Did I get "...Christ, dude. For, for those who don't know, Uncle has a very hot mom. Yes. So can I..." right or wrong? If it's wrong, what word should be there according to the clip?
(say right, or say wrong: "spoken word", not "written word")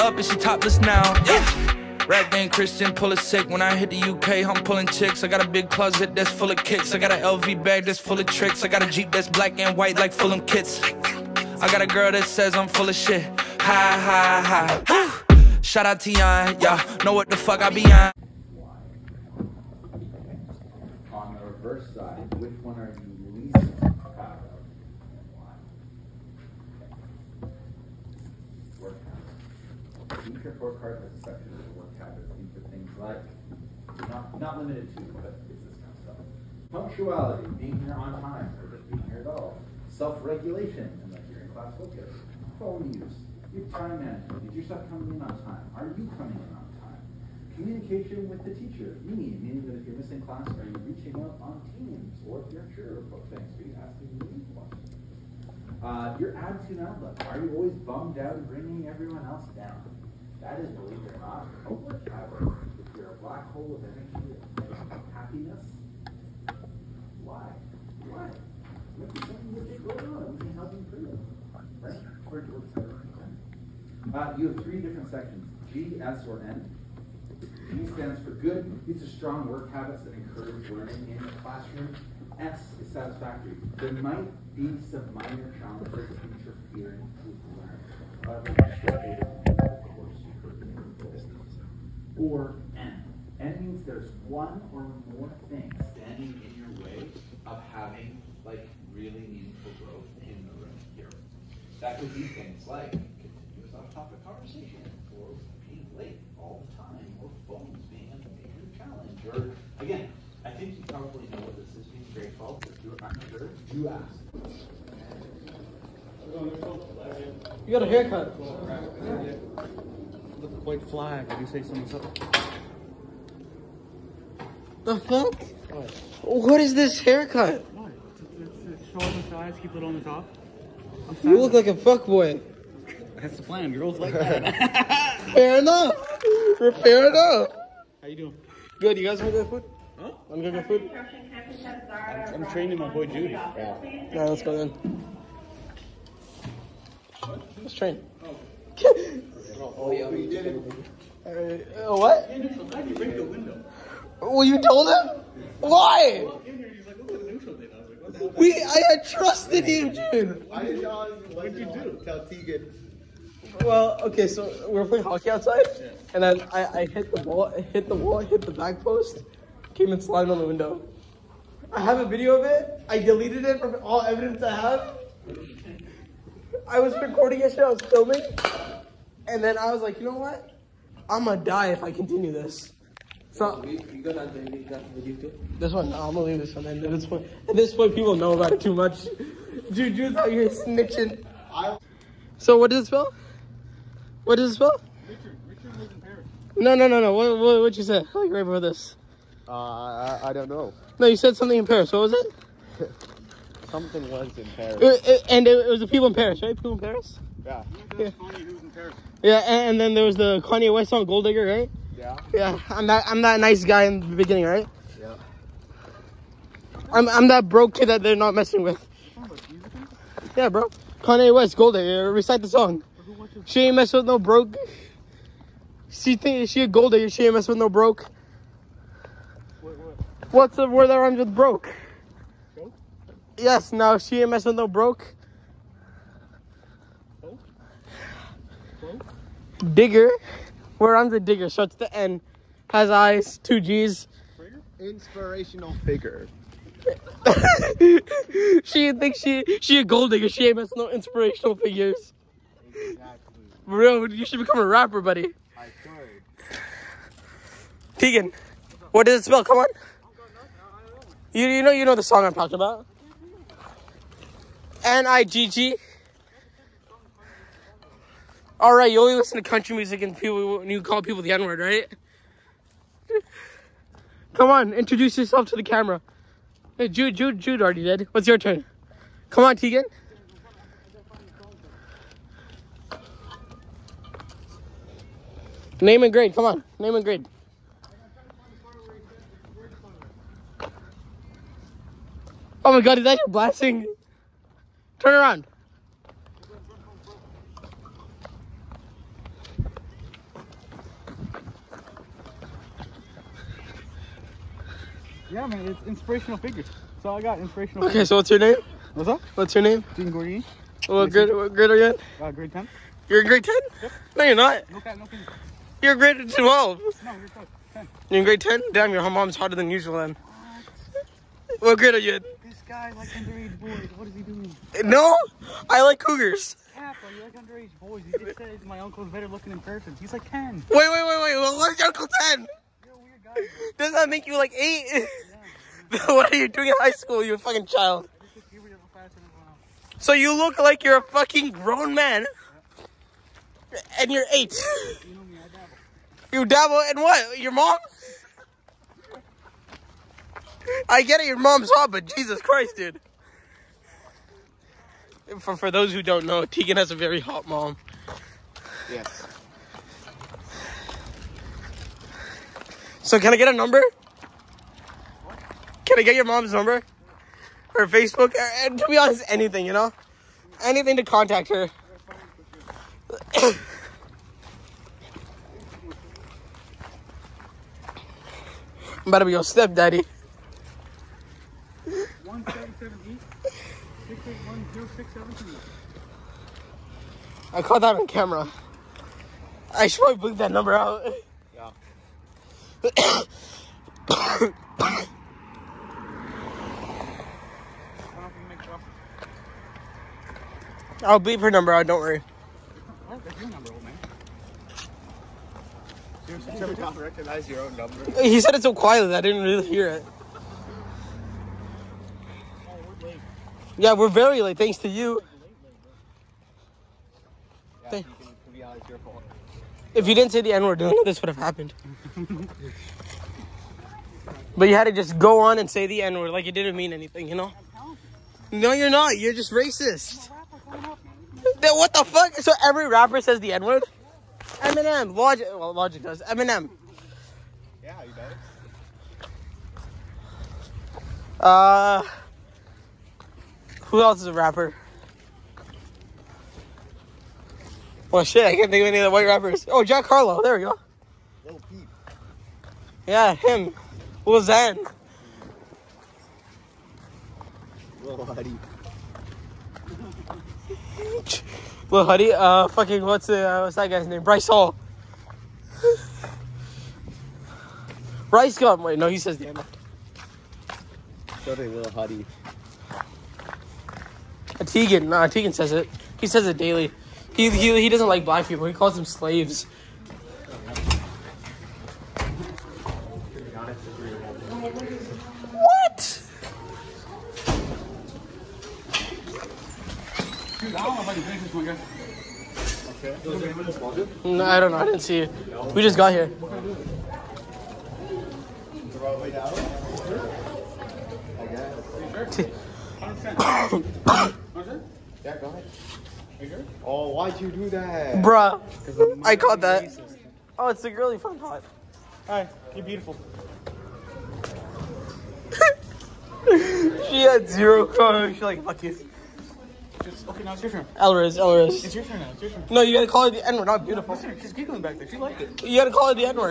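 wrong: "Tegan", not "Uncle".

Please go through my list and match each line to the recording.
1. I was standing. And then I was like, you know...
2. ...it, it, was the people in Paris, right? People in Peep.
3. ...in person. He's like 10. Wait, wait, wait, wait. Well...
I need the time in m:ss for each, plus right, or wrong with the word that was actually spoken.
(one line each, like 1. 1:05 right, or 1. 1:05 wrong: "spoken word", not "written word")
1. 2:57 wrong: "filming", not "standing"
2. 3:25 wrong: "Paris", not "Peep"
3. 5:29 right.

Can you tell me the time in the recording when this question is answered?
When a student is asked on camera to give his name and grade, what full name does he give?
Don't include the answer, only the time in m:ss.
5:09.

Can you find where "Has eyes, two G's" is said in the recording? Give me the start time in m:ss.
4:02.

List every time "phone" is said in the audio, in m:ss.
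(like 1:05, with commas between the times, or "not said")
0:42, 1:47.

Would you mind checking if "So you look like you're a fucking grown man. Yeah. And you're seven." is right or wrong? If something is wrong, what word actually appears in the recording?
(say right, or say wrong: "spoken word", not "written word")
wrong: "eight", not "seven".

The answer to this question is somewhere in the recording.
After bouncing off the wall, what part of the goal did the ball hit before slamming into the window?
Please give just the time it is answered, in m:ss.
2:48.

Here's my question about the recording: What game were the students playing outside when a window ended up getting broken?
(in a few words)
Hockey.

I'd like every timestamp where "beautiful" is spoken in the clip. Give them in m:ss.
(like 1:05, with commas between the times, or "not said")
8:32, 8:43.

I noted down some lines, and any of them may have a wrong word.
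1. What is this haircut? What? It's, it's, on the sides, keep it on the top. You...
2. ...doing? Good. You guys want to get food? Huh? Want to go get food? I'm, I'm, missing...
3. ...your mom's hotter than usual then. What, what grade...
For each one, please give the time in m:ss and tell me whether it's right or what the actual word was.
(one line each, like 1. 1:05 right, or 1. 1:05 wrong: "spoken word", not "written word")
1. 2:06 right
2. 2:18 wrong: "training", not "missing"
3. 5:18 right.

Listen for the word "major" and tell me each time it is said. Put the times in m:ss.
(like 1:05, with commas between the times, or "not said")
1:48.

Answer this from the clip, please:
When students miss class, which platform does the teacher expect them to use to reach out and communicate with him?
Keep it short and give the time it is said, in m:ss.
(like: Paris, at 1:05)
Teams, at 0:51.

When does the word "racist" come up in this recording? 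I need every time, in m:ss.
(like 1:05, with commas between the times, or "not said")
7:09, 8:29.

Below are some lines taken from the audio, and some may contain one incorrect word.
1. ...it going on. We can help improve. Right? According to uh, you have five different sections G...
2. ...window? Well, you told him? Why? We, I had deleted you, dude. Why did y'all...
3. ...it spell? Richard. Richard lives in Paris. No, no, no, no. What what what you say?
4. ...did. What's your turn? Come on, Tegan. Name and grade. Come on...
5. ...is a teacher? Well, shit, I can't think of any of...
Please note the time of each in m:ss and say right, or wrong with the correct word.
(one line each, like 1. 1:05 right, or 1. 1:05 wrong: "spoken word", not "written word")
1. 1:09 wrong: "three", not "five"
2. 2:33 wrong: "trusted", not "deleted"
3. 3:14 right
4. 4:37 right
5. 7:24 wrong: "rapper", not "teacher".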